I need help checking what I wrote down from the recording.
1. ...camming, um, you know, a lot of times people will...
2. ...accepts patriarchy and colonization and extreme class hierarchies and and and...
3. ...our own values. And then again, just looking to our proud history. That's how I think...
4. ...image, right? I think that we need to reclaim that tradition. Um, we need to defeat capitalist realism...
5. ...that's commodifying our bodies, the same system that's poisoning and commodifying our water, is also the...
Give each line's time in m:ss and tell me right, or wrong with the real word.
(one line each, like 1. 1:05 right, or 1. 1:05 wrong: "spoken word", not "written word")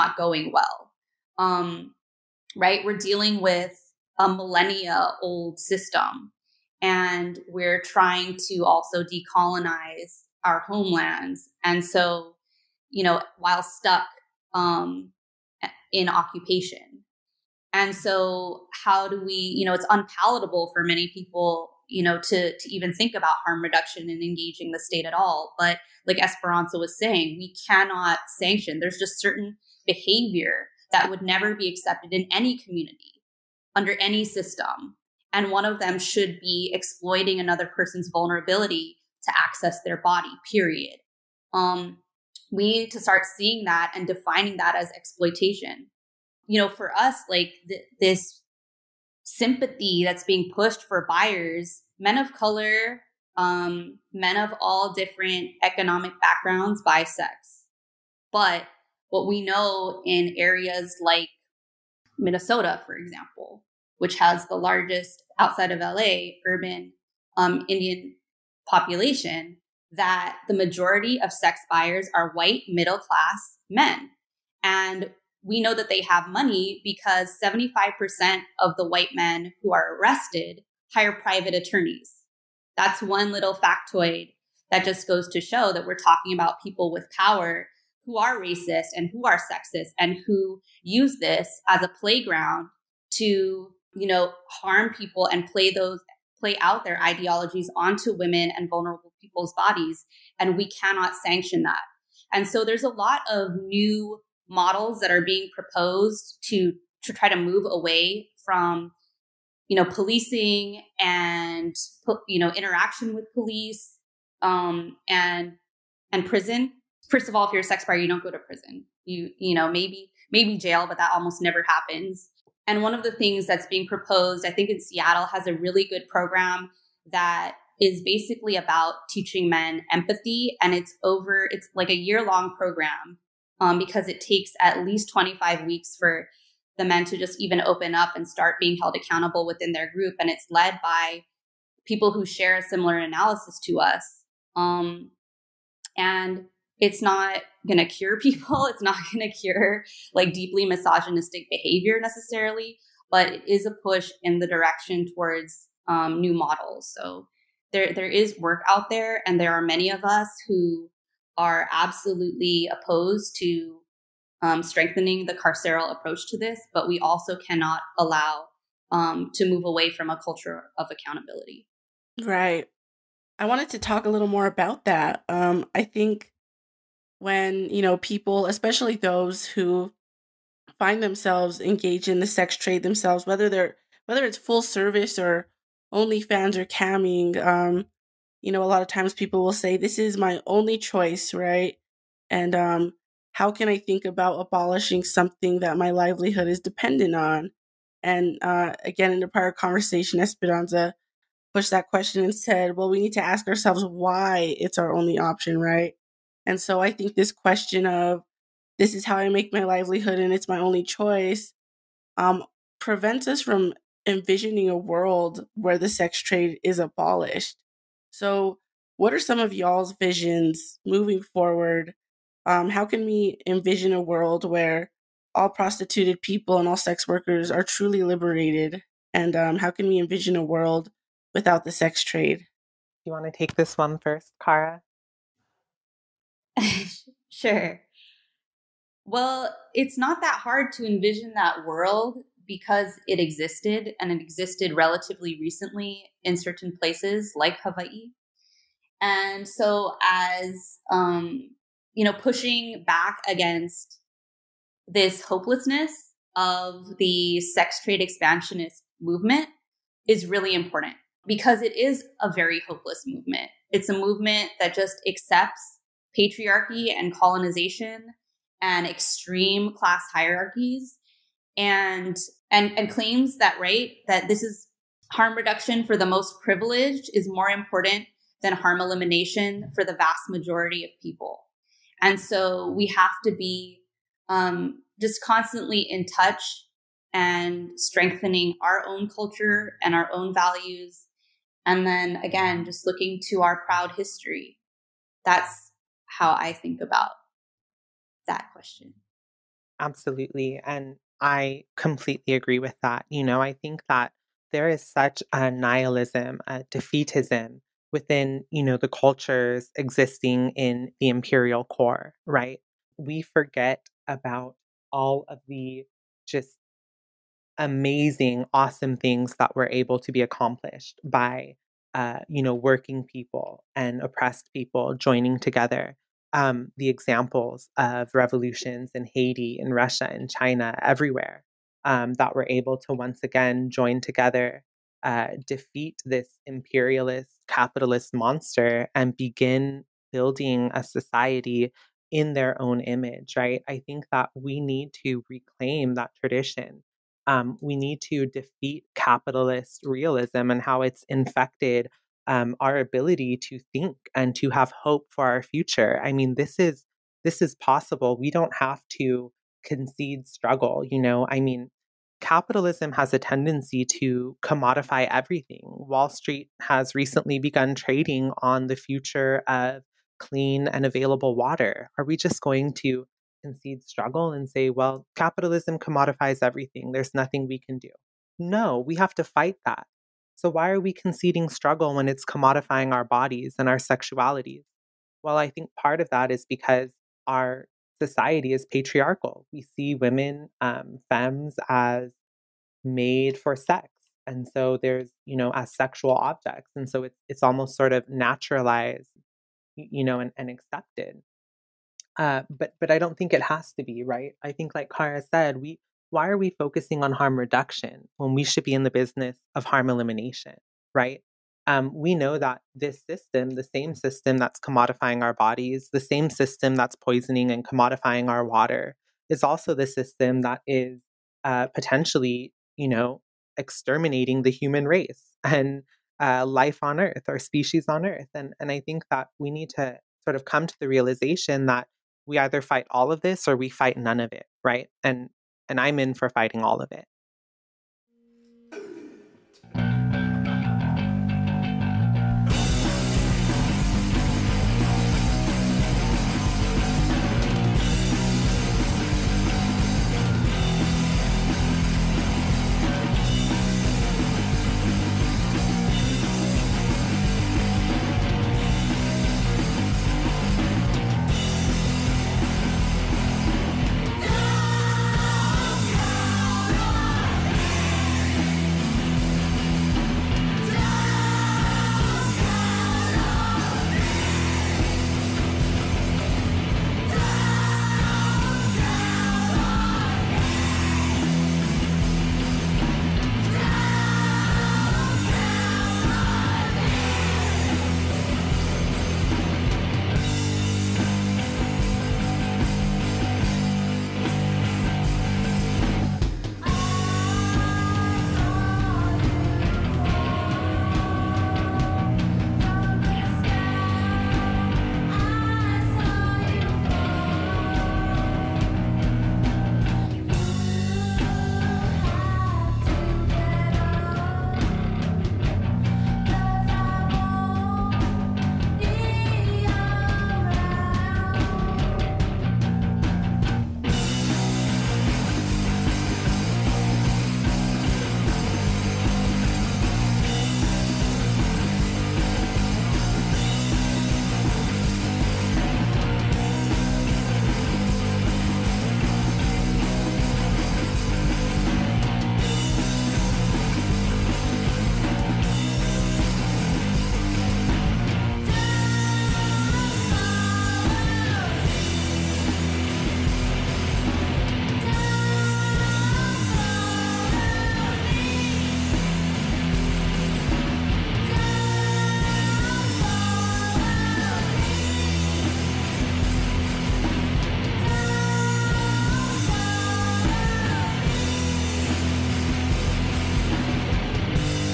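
1. 3:06 right
2. 4:25 right
3. 4:49 right
4. 5:42 right
5. 6:54 right.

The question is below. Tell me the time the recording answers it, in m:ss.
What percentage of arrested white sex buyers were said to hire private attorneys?
1:17.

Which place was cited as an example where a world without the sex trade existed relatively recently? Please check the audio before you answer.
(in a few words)
Hawaii.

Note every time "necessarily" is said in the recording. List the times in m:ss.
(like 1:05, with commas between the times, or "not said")
2:32.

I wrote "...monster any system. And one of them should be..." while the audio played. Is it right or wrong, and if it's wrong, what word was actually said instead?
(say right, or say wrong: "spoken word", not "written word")
wrong: "under", not "monster".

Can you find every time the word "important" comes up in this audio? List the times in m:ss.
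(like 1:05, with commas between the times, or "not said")
4:20, 4:37.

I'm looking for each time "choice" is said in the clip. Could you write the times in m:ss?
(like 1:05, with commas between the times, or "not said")
3:10, 3:30.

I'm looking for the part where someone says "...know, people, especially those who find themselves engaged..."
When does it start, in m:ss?
2:57.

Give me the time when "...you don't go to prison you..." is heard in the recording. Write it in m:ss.
1:57.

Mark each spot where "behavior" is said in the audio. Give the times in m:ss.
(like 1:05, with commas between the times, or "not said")
0:29, 2:31.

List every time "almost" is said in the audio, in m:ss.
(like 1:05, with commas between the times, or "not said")
2:01, 6:37.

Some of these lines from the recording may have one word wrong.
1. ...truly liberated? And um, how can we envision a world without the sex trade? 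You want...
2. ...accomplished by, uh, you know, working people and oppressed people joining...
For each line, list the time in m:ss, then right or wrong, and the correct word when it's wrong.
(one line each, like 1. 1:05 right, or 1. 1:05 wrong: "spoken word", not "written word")
1. 3:47 right
2. 5:20 right.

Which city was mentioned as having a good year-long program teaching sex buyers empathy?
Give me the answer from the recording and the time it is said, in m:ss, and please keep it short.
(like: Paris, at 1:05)
Seattle, at 2:04.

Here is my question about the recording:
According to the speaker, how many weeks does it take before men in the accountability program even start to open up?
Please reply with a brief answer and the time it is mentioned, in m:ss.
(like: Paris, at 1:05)
25 weeks, at 2:15.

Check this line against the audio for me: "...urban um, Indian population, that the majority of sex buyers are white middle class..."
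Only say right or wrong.
right.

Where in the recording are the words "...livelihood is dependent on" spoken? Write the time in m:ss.
3:15.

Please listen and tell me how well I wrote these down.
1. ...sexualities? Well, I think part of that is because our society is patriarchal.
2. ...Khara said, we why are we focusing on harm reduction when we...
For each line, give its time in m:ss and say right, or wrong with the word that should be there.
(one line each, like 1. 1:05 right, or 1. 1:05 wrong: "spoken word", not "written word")
1. 6:23 right
2. 6:44 right.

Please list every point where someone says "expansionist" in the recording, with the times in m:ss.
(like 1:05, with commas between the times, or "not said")
4:18.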